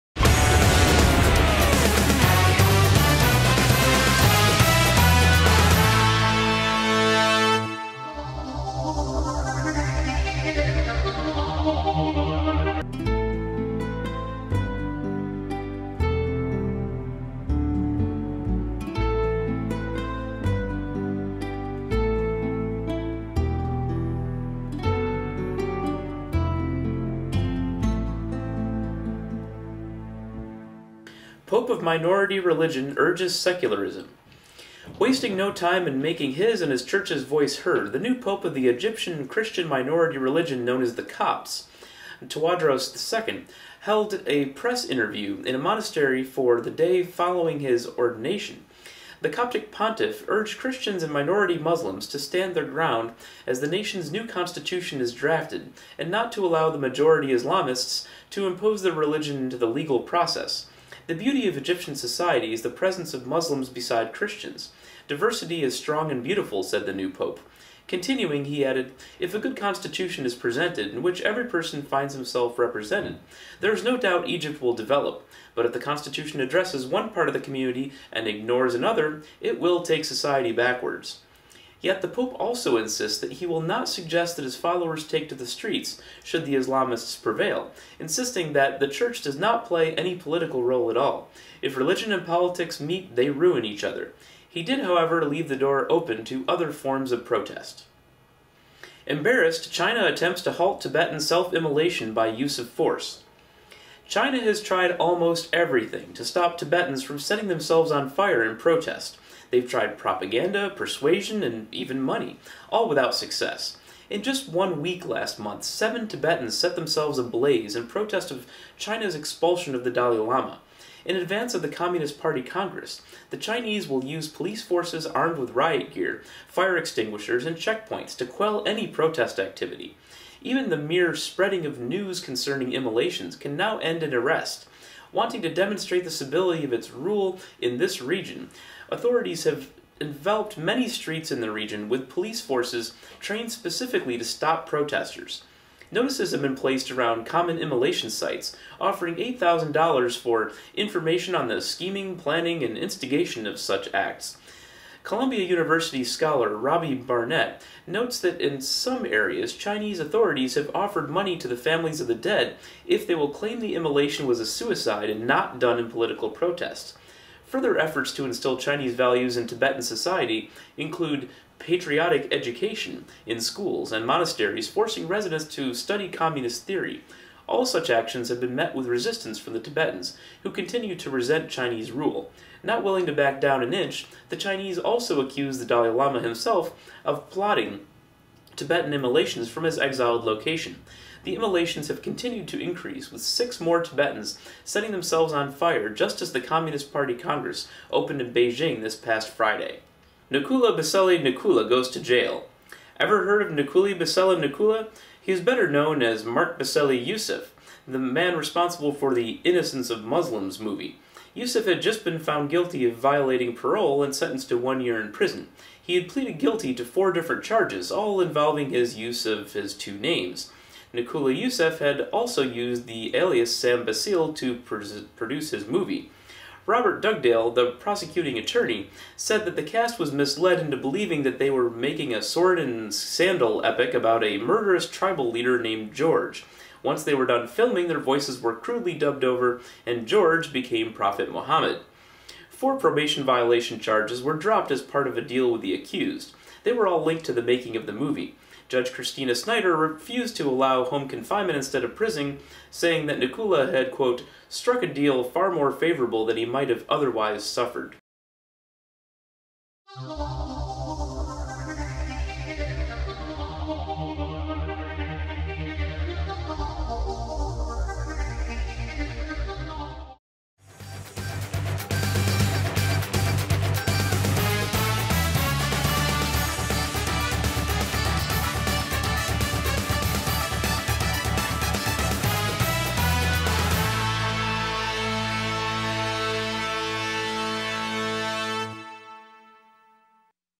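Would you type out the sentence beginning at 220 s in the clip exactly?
Nakoula Youssef had also used the alias Sam Bacile to produce his movie.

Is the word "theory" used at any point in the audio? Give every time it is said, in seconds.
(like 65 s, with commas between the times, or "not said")
176 s.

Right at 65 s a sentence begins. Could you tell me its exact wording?
Diversity is strong and beautiful, said the new pope.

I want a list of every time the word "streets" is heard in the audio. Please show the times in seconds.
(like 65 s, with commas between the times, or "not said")
85 s, 140 s.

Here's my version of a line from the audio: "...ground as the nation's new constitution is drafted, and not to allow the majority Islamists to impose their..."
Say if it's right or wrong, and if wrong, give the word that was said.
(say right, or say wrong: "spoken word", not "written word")
right.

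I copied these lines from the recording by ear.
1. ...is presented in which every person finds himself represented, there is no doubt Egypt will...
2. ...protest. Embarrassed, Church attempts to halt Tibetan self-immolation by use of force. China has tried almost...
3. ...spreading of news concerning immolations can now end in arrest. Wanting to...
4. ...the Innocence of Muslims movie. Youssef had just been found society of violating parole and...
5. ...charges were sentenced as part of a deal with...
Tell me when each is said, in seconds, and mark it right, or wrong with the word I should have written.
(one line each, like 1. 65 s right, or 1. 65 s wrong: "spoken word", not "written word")
1. 70 s right
2. 97 s wrong: "China", not "Church"
3. 131 s right
4. 209 s wrong: "guilty", not "society"
5. 243 s wrong: "dropped", not "sentenced".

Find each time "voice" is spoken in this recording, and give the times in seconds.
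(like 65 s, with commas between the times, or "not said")
37 s, 237 s.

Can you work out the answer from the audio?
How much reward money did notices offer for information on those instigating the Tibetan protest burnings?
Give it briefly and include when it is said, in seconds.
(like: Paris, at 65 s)
$8,000, at 149 s.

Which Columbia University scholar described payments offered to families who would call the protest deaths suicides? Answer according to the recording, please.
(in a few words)
Robbie Barnett.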